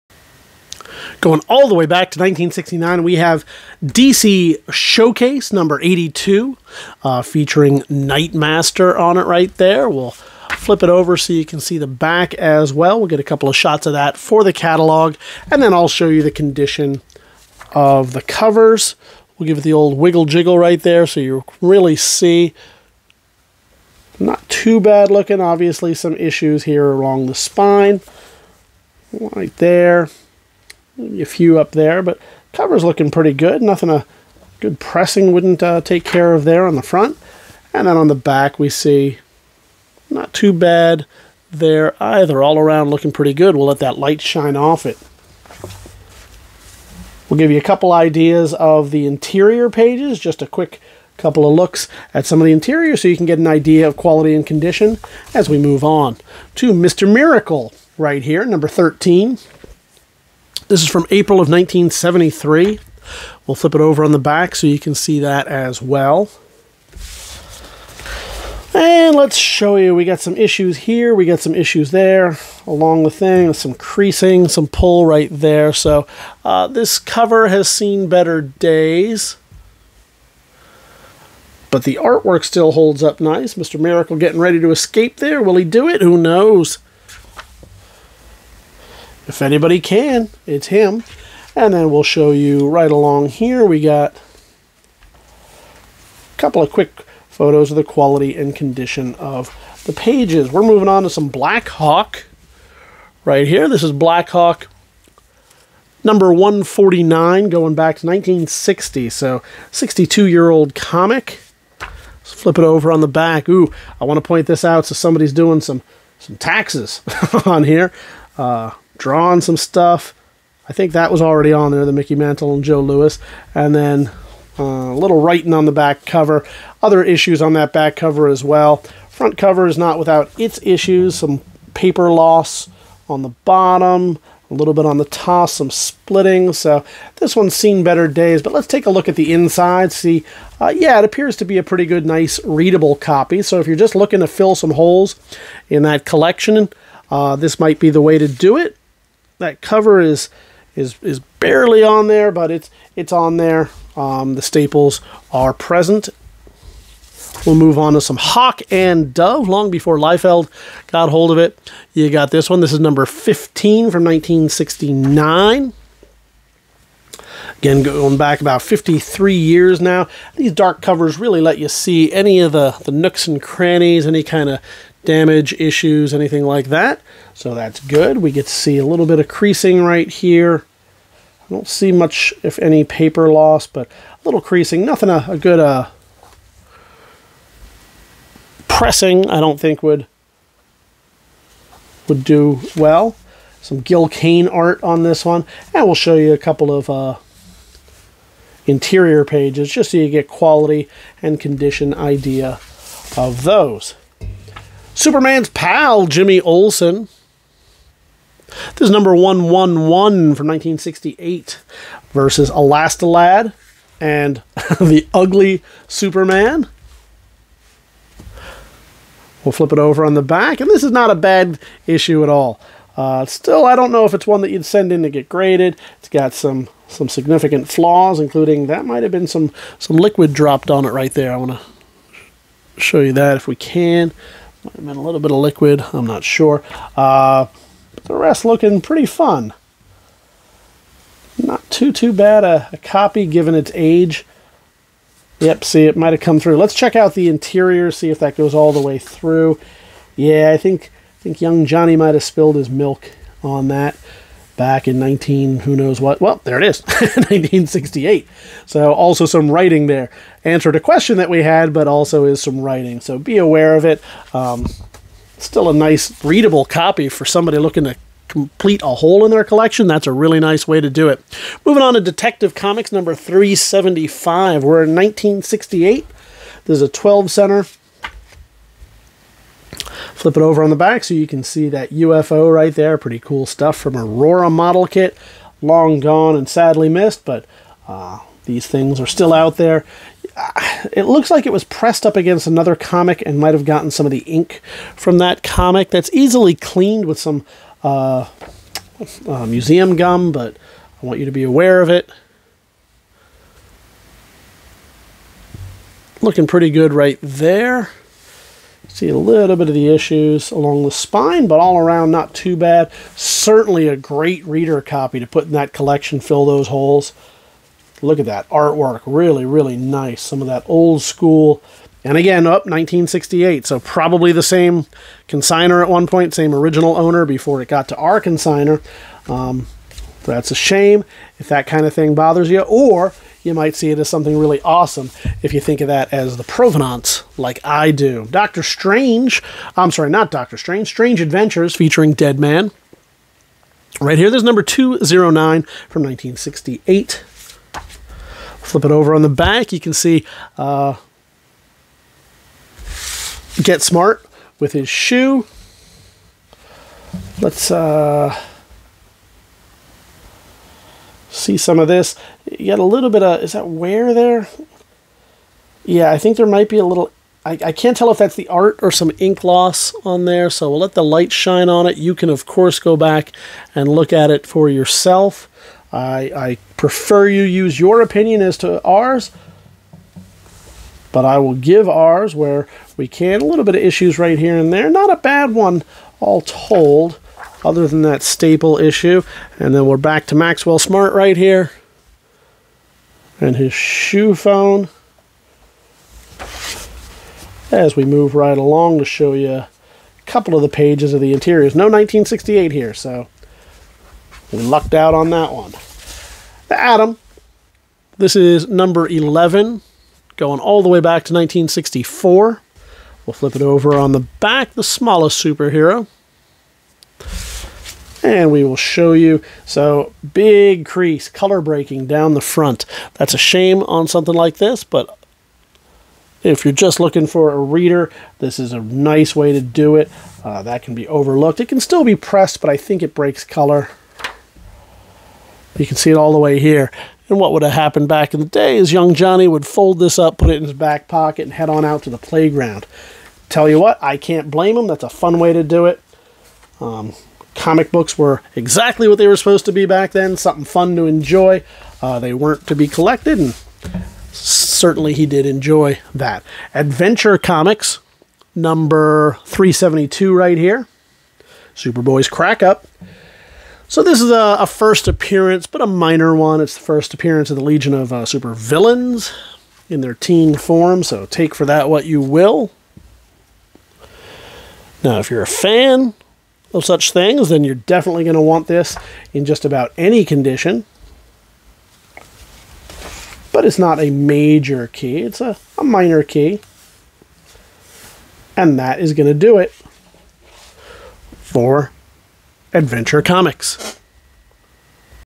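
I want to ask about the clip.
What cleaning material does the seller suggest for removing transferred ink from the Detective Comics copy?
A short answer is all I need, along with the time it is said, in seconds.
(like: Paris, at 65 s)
museum gum, at 299 s.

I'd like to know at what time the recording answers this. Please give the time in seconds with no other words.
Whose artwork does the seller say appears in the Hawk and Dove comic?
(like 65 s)
193 s.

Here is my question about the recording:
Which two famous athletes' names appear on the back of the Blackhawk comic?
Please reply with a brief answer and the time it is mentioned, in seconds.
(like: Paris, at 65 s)
Mickey Mantle and Joe Louis, at 121 s.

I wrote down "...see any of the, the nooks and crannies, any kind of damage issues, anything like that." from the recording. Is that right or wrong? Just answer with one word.
right.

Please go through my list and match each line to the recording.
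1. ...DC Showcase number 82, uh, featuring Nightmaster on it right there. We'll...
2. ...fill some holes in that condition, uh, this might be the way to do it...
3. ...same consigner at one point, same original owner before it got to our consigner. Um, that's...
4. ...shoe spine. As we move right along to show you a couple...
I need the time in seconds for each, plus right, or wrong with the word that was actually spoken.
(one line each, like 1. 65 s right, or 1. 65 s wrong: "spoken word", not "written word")
1. 3 s right
2. 144 s wrong: "collection", not "condition"
3. 324 s right
4. 393 s wrong: "phone", not "spine".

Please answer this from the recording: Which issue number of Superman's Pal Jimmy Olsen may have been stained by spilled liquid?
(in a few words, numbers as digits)
111.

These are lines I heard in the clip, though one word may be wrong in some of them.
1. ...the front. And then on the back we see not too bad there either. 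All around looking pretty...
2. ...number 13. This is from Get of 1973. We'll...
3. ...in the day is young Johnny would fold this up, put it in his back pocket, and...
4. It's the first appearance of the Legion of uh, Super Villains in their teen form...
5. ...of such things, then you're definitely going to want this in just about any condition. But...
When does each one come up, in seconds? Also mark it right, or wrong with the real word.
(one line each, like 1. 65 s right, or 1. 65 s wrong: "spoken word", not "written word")
1. 36 s right
2. 58 s wrong: "April", not "Get"
3. 438 s right
4. 466 s right
5. 476 s right.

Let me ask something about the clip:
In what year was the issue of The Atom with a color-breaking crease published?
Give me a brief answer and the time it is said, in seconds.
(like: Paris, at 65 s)
1964, at 411 s.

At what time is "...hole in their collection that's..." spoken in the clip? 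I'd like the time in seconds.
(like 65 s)
268 s.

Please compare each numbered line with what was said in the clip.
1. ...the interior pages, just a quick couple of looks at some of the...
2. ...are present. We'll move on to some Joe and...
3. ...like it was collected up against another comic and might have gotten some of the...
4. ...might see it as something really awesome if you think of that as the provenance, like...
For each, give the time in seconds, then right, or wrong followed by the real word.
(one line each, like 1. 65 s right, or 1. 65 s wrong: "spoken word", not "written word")
1. 48 s right
2. 155 s wrong: "Hawk", not "Joe"
3. 291 s wrong: "pressed", not "collected"
4. 333 s right.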